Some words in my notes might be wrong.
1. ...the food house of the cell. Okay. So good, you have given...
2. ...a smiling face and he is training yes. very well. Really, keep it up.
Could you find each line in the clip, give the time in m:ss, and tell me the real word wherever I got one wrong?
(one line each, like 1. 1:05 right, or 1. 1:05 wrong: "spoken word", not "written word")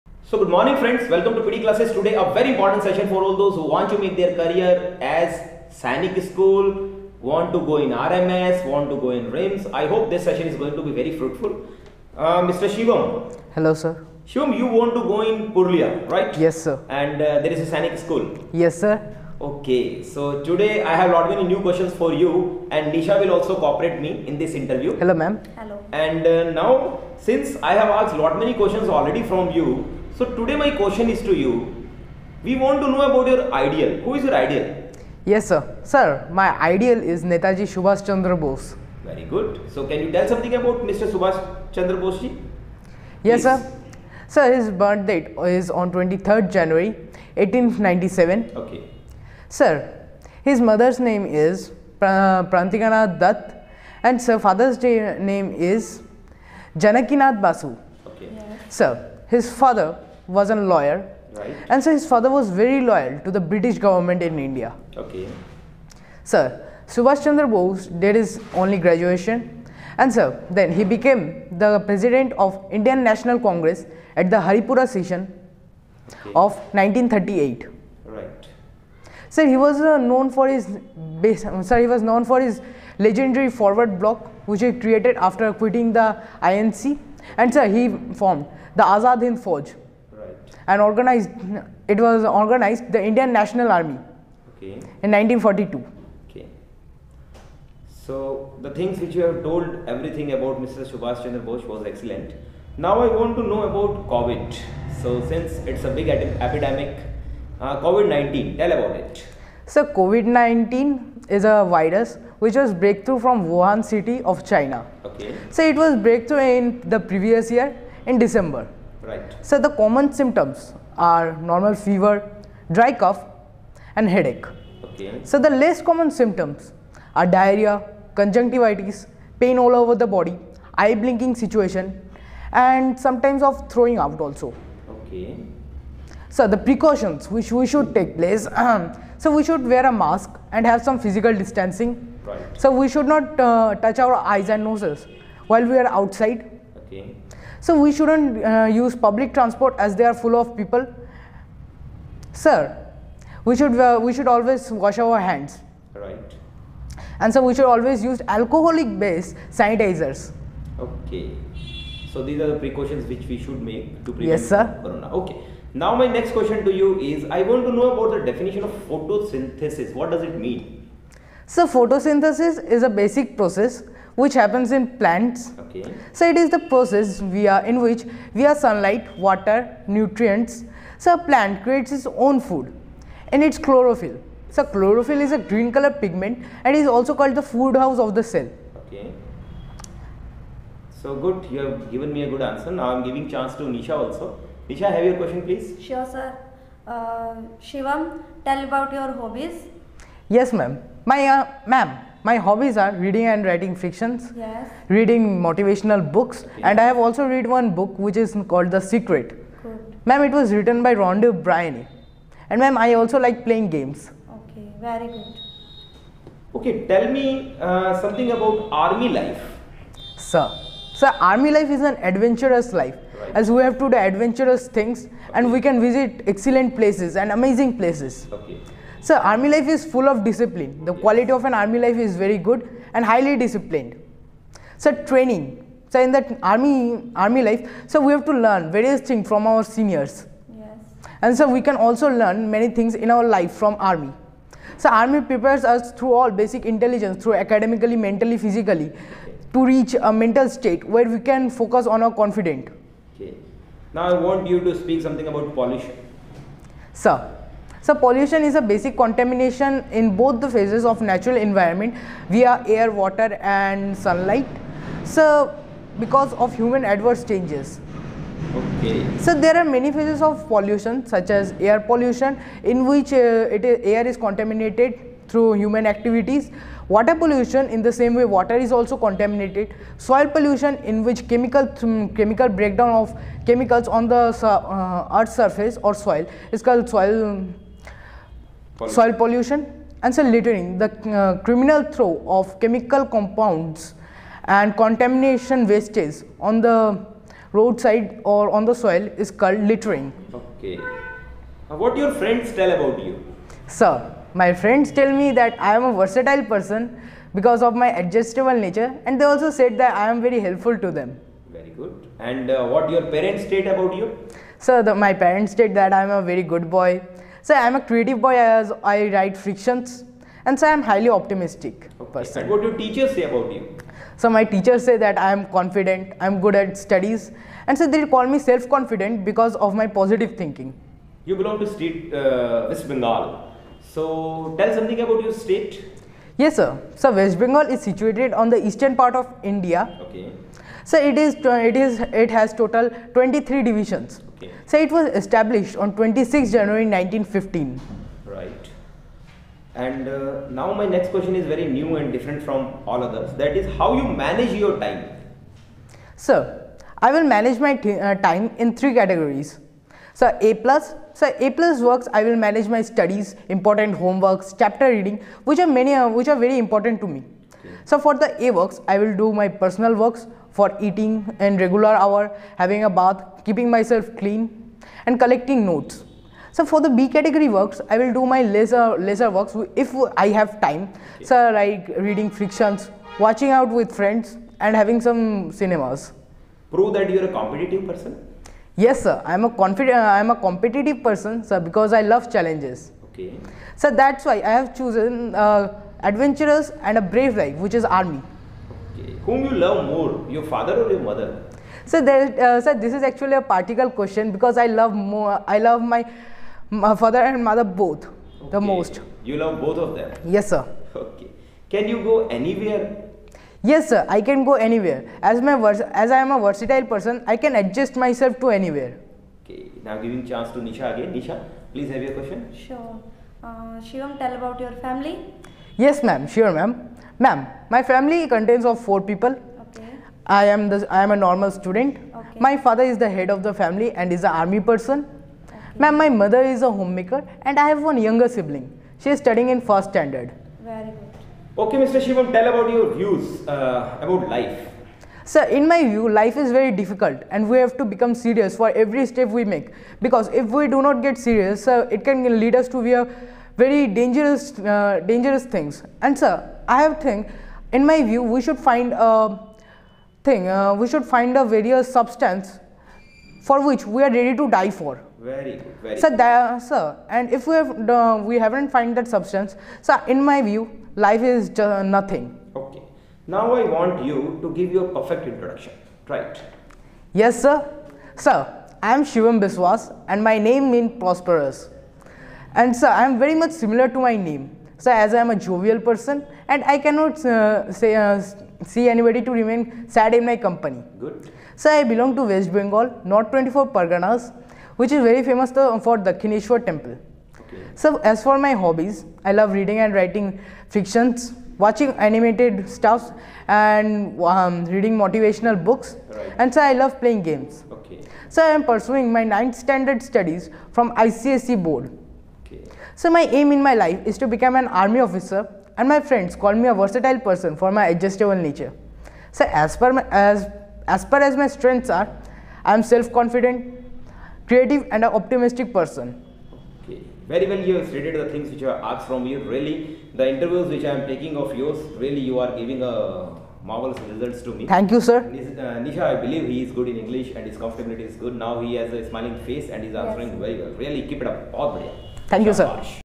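1. 3:07 right
2. 8:59 wrong: "answering", not "training".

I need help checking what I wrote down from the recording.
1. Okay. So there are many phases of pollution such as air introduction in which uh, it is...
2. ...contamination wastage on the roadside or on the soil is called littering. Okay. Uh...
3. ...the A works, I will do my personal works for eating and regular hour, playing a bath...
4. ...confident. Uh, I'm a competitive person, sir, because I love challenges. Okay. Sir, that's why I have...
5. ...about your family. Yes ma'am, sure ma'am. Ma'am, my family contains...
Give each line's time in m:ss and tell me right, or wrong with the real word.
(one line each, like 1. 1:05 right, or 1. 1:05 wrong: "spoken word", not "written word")
1. 4:28 wrong: "pollution", not "introduction"
2. 4:54 right
3. 6:08 wrong: "having", not "playing"
4. 6:29 right
5. 7:04 right.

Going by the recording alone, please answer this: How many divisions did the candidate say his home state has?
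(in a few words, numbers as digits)
23.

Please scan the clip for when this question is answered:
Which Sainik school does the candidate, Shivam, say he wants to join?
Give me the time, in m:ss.
0:15.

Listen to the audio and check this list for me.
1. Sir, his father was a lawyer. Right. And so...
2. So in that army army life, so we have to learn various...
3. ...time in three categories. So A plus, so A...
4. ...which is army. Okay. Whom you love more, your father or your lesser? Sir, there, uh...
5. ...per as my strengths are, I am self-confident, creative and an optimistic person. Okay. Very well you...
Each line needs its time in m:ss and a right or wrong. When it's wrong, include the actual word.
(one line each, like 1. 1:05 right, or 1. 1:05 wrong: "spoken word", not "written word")
1. 0:58 right
2. 3:55 right
3. 5:58 right
4. 6:37 wrong: "mother", not "lesser"
5. 8:41 right.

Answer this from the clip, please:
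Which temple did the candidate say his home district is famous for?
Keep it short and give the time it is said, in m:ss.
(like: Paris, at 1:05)
Dakshineshwar temple, at 8:16.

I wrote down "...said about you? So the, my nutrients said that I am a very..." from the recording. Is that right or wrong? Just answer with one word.
wrong.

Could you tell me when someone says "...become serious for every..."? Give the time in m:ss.
7:27.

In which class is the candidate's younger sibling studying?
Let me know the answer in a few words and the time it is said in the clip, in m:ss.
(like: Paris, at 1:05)
First standard, at 7:19.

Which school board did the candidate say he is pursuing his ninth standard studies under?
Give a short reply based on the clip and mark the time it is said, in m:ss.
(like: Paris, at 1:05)
ICSE, at 8:30.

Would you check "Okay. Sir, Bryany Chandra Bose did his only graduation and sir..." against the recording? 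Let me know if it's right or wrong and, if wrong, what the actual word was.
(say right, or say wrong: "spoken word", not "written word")
wrong: "Subhash", not "Bryany".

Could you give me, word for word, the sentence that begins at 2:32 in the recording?
Sir, we should uh, we should always wash our hands.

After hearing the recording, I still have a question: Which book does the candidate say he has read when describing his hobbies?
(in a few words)
The Secret.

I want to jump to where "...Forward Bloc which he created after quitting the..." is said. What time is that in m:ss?
1:23.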